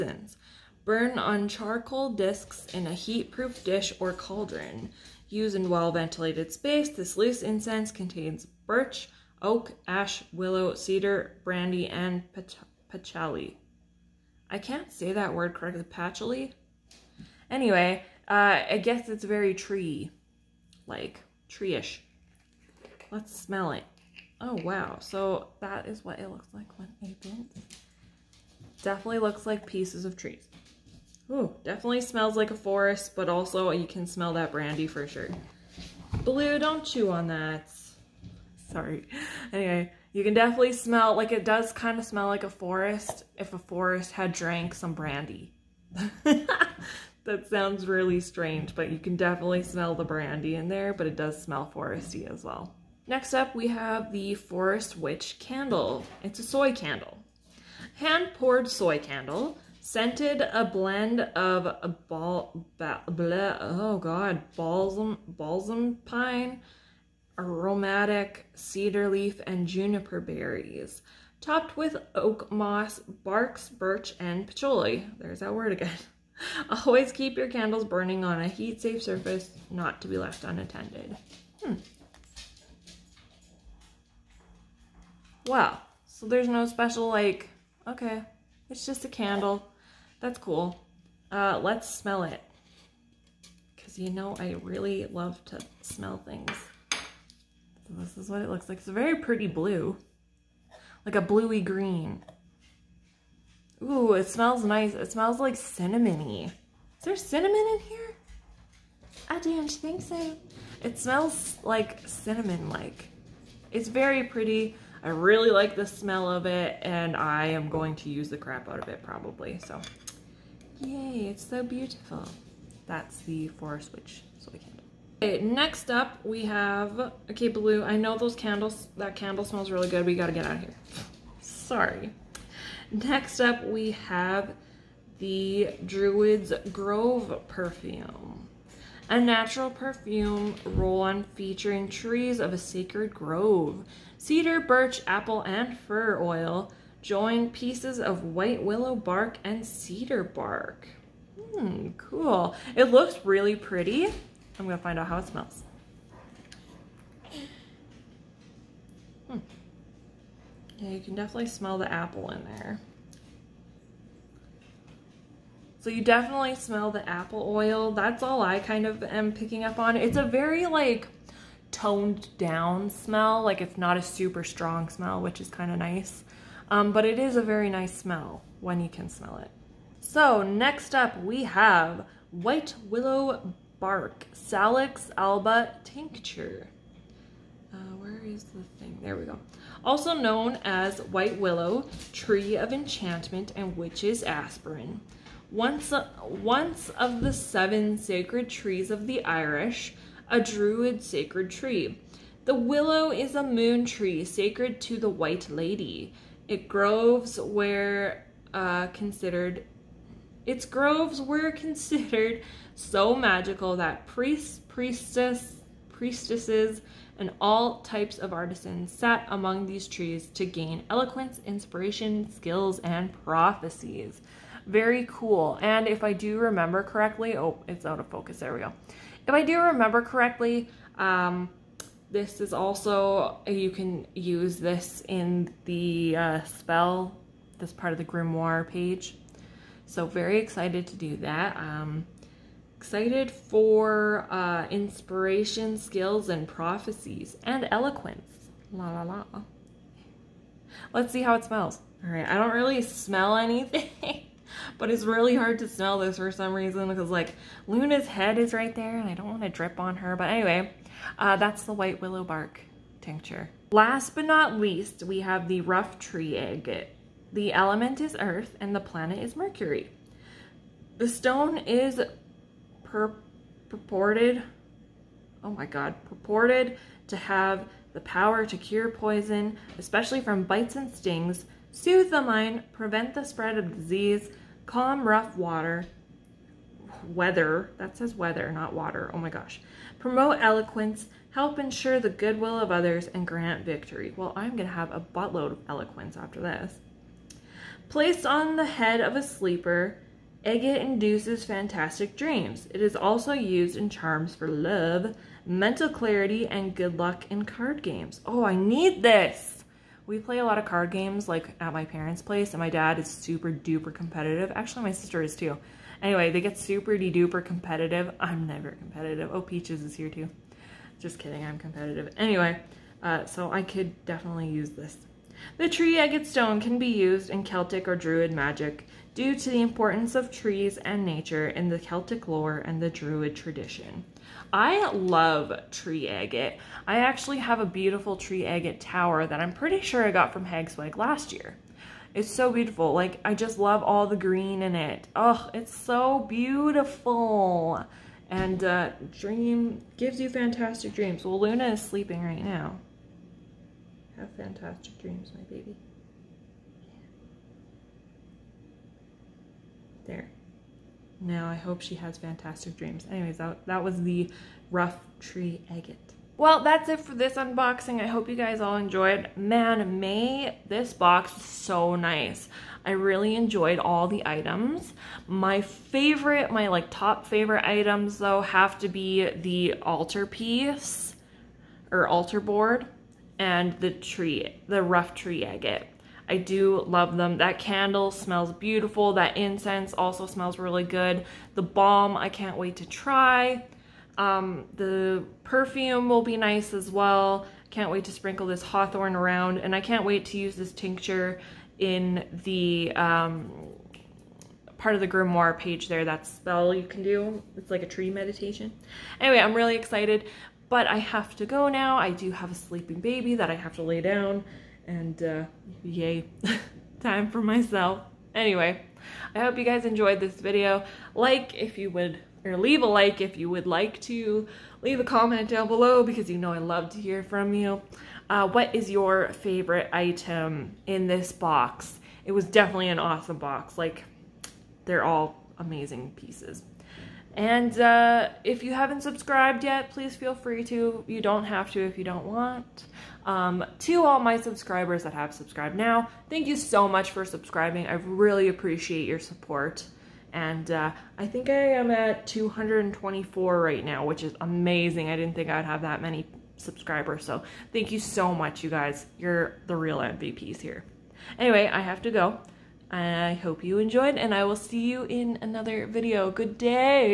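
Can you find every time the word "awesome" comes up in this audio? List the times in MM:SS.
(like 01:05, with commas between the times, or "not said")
07:12.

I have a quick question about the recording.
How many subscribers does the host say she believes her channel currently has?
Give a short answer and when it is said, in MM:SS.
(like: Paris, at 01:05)
224, at 07:32.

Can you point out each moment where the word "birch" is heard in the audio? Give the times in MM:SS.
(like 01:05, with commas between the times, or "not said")
00:08, 01:13, 02:24.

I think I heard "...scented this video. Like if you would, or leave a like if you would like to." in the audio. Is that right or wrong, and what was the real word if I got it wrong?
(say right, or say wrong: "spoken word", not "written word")
wrong: "enjoyed", not "scented".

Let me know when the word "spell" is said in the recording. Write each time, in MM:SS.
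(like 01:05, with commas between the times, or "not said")
03:56, 06:46.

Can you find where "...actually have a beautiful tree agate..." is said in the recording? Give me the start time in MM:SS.
05:36.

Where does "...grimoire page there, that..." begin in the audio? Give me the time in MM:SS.
06:45.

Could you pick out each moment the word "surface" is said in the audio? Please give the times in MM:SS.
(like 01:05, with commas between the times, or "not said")
01:19.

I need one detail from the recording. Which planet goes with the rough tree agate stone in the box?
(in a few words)
Mercury.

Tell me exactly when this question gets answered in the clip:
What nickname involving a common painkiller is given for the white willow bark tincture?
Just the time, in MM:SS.
03:13.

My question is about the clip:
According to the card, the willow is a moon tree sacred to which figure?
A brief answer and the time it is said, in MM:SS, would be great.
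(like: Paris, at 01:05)
the White Lady, at 03:25.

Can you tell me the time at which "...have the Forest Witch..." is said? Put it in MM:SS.
00:53.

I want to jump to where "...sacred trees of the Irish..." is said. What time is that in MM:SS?
03:17.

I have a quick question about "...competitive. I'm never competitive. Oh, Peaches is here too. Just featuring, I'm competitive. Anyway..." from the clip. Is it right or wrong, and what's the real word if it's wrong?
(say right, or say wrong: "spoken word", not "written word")
wrong: "kidding", not "featuring".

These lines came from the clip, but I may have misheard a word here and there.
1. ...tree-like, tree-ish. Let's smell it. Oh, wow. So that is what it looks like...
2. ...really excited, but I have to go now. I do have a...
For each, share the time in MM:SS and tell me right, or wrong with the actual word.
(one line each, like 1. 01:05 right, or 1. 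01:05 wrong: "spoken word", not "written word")
1. 00:19 right
2. 06:49 right.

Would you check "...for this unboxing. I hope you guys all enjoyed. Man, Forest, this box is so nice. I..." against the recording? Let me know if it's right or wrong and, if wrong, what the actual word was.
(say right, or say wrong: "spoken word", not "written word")
wrong: "May", not "Forest".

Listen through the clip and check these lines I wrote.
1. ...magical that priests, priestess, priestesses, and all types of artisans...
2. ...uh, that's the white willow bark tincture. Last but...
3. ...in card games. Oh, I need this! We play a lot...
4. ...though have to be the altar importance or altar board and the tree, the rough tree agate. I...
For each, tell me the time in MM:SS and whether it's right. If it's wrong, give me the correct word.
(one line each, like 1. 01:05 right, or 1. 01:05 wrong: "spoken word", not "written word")
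1. 03:33 right
2. 04:21 right
3. 05:07 right
4. 06:18 wrong: "piece", not "importance".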